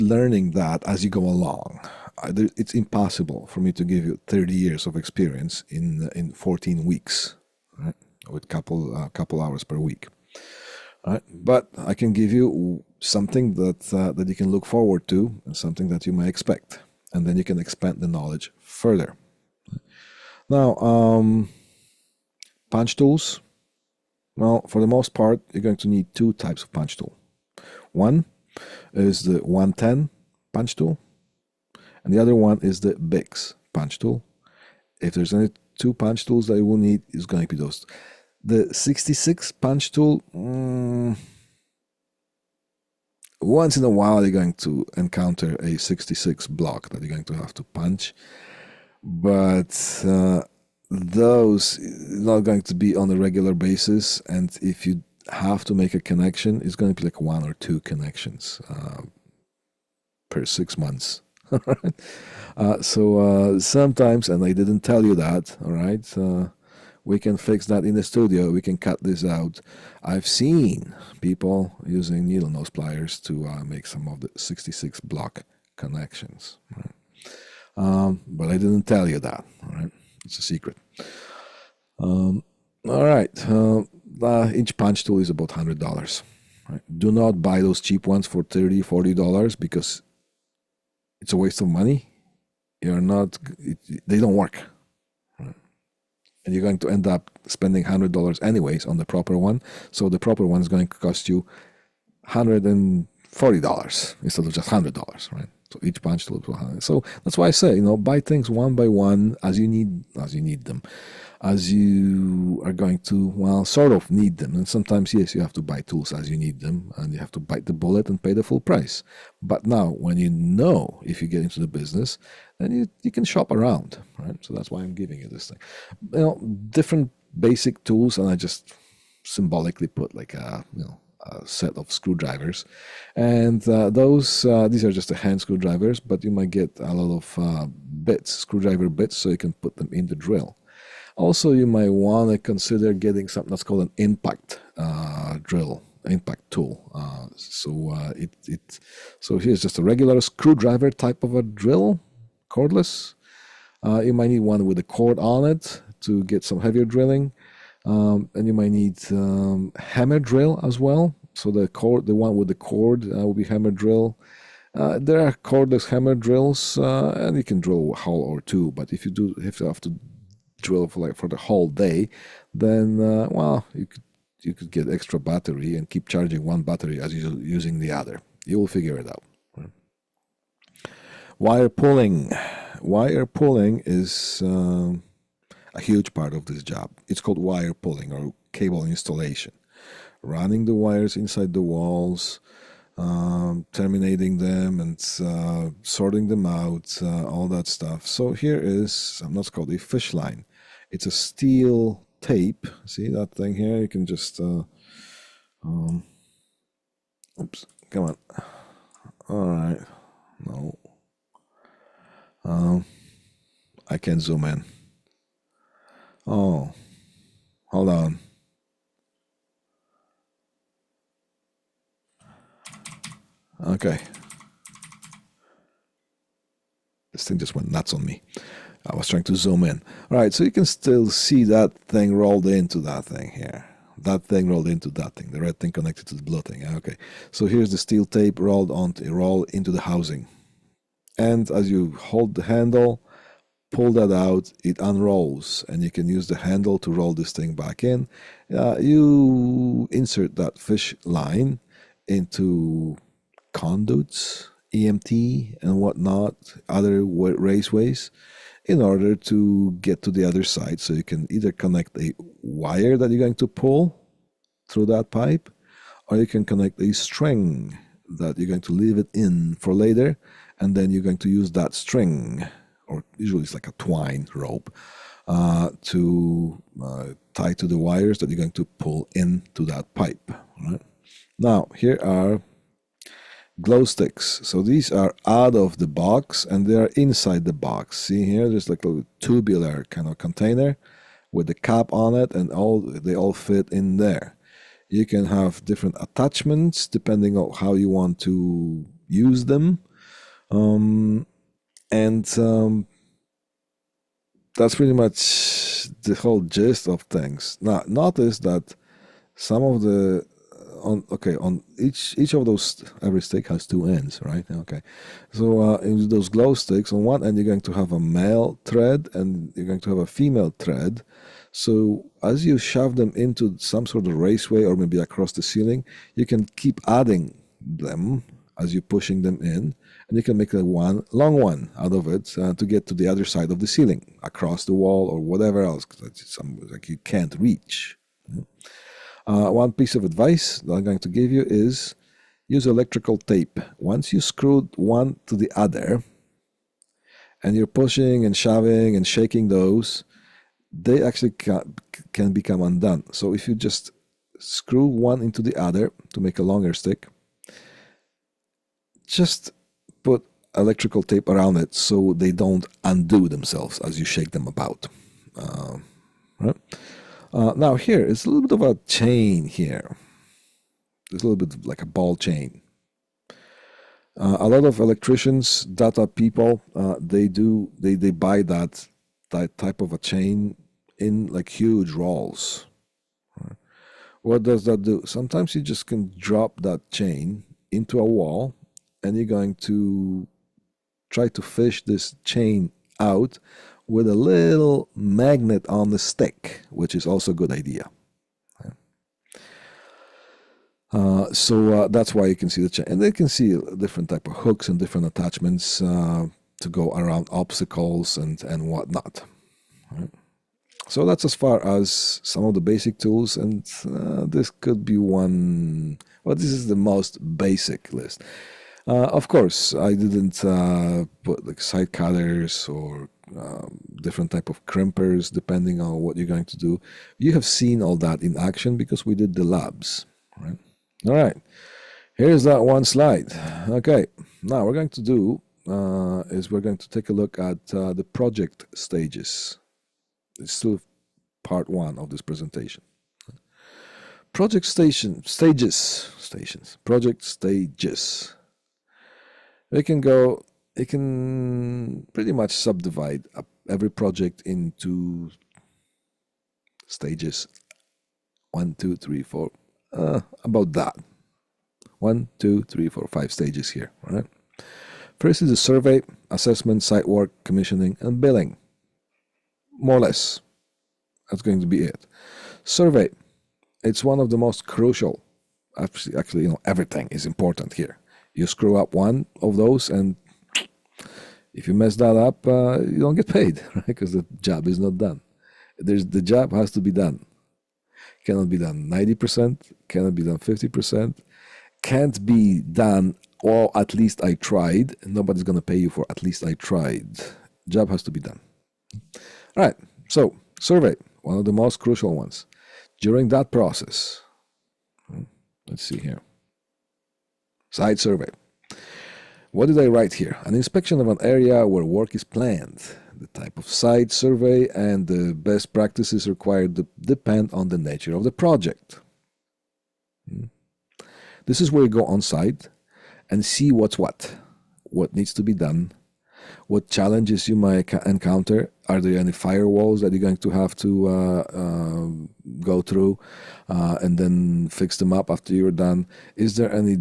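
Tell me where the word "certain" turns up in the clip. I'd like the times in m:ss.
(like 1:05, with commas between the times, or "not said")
not said.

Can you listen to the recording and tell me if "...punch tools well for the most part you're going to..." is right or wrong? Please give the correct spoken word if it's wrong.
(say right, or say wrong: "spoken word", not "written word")
right.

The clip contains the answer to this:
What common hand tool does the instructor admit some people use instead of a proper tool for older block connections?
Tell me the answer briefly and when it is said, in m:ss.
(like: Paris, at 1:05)
needle nose pliers, at 1:12.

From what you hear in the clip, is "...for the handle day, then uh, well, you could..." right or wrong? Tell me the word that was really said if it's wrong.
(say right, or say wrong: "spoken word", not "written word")
wrong: "whole", not "handle".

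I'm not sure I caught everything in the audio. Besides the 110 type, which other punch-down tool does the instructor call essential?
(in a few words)
Bix.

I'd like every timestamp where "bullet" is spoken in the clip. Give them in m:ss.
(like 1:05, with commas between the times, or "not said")
1:57.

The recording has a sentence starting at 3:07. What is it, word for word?
It's called wire pulling or cable installation, running the wires inside the walls.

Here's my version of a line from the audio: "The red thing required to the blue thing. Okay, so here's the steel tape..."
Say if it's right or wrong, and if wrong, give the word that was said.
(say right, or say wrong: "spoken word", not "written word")
wrong: "connected", not "required".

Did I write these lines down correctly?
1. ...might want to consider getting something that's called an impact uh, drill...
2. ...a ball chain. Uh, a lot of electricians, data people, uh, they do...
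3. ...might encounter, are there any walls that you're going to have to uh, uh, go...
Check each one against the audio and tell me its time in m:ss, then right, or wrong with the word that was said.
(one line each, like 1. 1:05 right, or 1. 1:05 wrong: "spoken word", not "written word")
1. 2:21 right
2. 6:11 right
3. 8:47 wrong: "firewalls", not "walls".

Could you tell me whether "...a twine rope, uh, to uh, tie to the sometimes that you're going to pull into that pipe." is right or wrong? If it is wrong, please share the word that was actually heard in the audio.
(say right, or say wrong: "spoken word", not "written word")
wrong: "wires", not "sometimes".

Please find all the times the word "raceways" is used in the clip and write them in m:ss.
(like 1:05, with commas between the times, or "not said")
4:17, 5:24.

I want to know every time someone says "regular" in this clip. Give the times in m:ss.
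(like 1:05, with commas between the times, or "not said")
0:53, 2:29.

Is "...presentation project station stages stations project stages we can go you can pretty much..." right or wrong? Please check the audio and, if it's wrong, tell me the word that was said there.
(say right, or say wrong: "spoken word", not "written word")
right.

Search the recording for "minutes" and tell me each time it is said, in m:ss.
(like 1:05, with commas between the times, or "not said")
not said.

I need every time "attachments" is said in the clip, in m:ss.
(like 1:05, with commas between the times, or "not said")
4:56, 6:45.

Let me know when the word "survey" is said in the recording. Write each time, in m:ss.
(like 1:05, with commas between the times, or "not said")
7:45, 7:52, 8:20, 8:27, 8:34.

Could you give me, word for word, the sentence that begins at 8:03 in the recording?
Because the job is not done.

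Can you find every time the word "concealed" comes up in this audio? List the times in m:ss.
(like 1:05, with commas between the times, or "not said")
not said.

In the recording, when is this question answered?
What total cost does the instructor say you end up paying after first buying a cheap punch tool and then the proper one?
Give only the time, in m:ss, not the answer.
1:42.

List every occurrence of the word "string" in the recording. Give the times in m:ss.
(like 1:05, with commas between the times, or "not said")
4:26, 4:31.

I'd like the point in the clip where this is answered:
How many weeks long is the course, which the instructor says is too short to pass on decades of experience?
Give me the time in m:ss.
0:06.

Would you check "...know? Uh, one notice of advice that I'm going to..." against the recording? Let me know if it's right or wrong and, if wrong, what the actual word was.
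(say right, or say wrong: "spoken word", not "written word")
wrong: "piece", not "notice".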